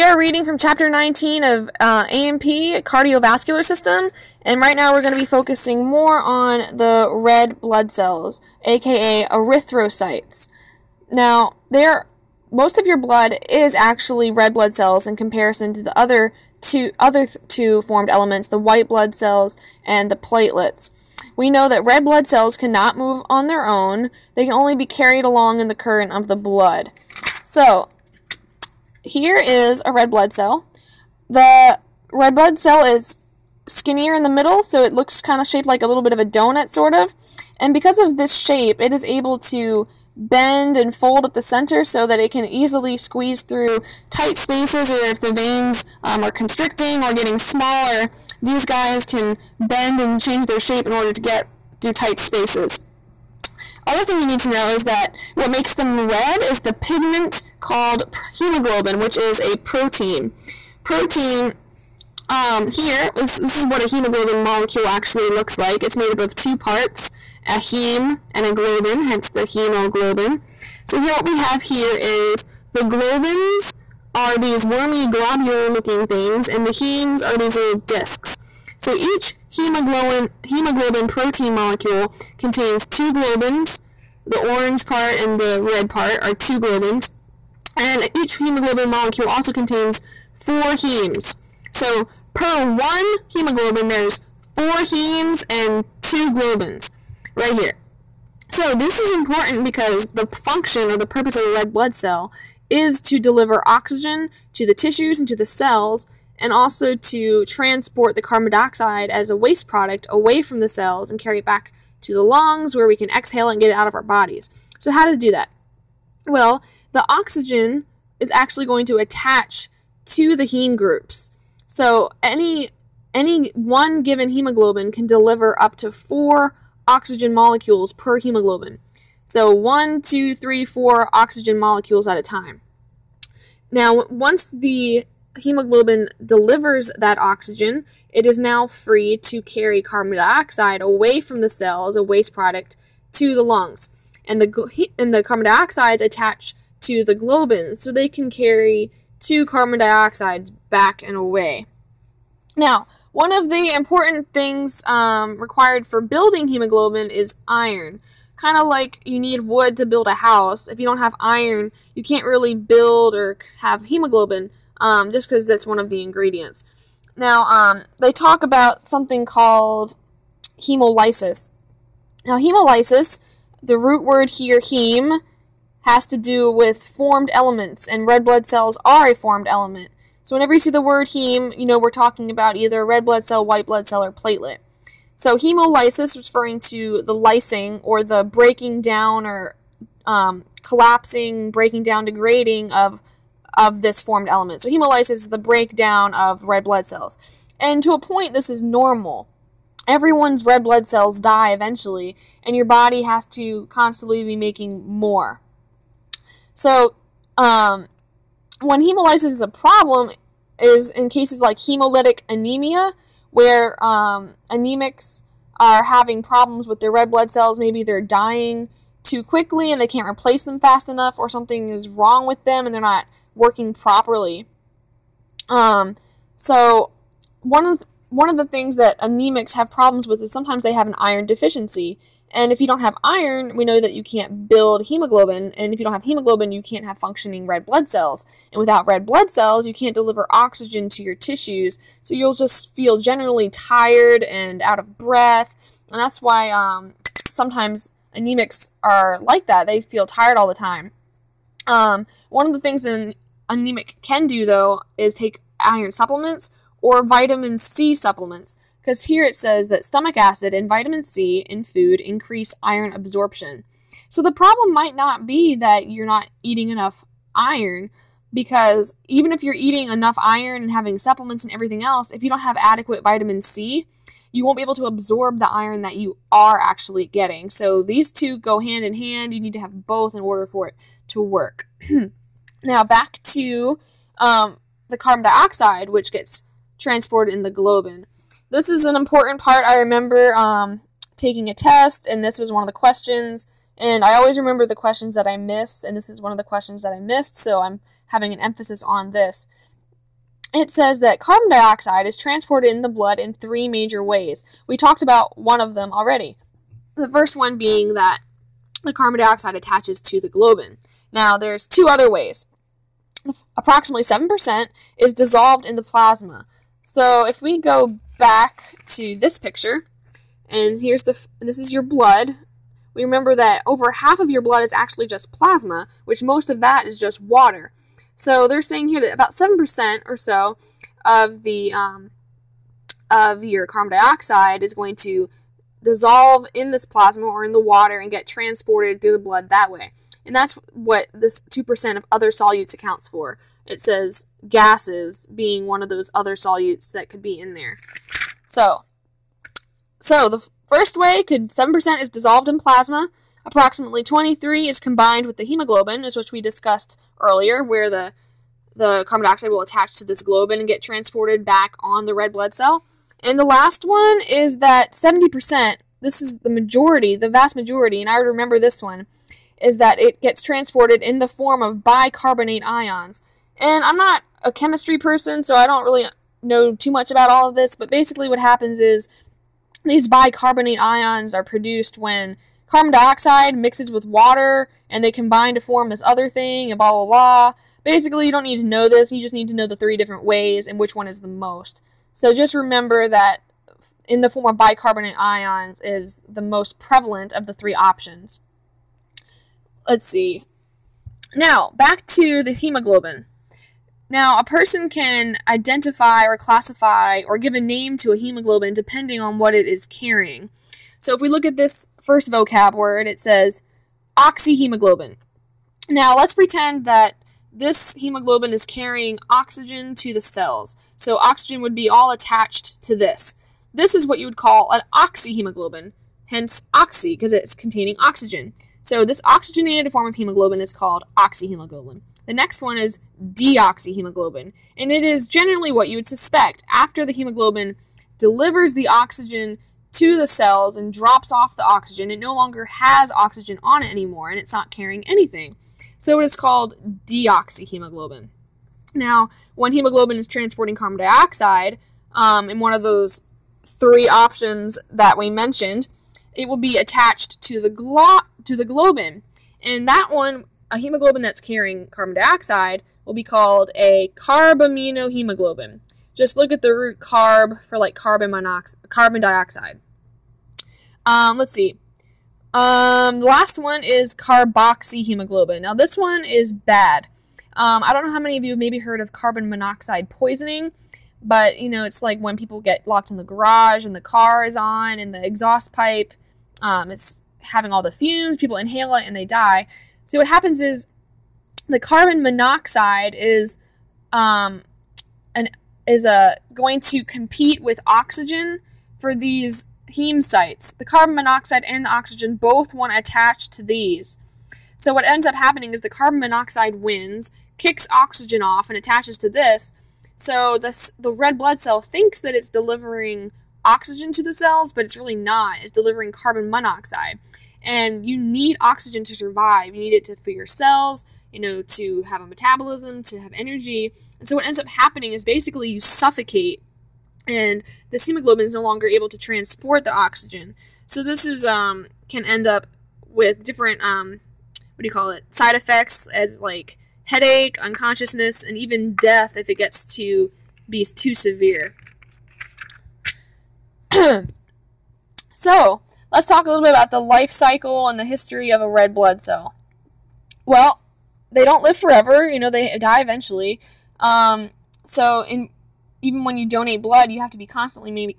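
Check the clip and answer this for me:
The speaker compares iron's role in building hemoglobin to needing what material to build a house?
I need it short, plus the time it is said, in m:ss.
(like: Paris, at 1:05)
wood, at 2:39.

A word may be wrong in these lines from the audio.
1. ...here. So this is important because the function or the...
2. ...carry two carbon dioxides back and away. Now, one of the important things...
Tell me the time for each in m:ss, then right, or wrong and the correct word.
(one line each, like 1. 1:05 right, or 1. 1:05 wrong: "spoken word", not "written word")
1. 1:37 right
2. 2:28 right.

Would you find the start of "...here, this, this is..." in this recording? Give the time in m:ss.
1:02.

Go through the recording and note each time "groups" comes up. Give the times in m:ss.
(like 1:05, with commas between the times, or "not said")
2:00.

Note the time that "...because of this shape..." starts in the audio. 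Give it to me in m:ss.
0:37.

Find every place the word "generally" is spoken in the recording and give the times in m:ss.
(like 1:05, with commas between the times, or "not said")
4:02, 7:15.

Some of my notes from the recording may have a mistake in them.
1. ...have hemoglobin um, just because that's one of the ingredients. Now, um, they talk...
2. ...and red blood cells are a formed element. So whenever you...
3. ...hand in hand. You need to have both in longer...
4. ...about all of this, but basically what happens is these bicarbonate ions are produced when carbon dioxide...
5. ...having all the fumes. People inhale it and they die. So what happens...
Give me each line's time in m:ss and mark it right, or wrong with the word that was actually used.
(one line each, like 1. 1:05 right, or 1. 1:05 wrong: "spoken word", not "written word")
1. 2:43 right
2. 2:57 right
3. 4:38 wrong: "order", not "longer"
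4. 6:17 right
5. 8:07 right.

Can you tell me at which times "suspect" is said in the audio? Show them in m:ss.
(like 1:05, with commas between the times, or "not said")
7:16.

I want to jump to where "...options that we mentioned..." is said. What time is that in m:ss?
7:34.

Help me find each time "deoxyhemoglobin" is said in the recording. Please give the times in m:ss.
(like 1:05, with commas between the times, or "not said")
7:13, 7:27.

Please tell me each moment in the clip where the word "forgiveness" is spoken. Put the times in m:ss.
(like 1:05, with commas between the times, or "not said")
not said.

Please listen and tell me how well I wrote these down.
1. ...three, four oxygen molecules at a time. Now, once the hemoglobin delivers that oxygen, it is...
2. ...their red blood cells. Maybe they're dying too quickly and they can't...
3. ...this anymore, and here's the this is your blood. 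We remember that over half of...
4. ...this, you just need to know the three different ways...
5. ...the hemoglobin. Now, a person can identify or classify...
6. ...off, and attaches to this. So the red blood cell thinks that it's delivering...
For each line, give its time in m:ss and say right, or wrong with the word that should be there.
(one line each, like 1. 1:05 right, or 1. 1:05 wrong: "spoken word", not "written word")
1. 2:10 right
2. 3:36 right
3. 5:19 wrong: "picture", not "anymore"
4. 6:28 right
5. 6:42 right
6. 8:28 right.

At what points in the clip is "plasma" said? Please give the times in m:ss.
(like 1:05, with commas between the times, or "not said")
5:15, 5:25, 5:36, 5:52.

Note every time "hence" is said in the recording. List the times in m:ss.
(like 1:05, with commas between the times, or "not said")
1:09, 7:06.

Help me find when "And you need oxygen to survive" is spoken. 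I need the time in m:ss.
8:37.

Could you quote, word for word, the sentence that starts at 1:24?
The orange part and the red part are two globins and each hemoglobin molecule also contains four hemes.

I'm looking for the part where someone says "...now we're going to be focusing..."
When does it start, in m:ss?
0:04.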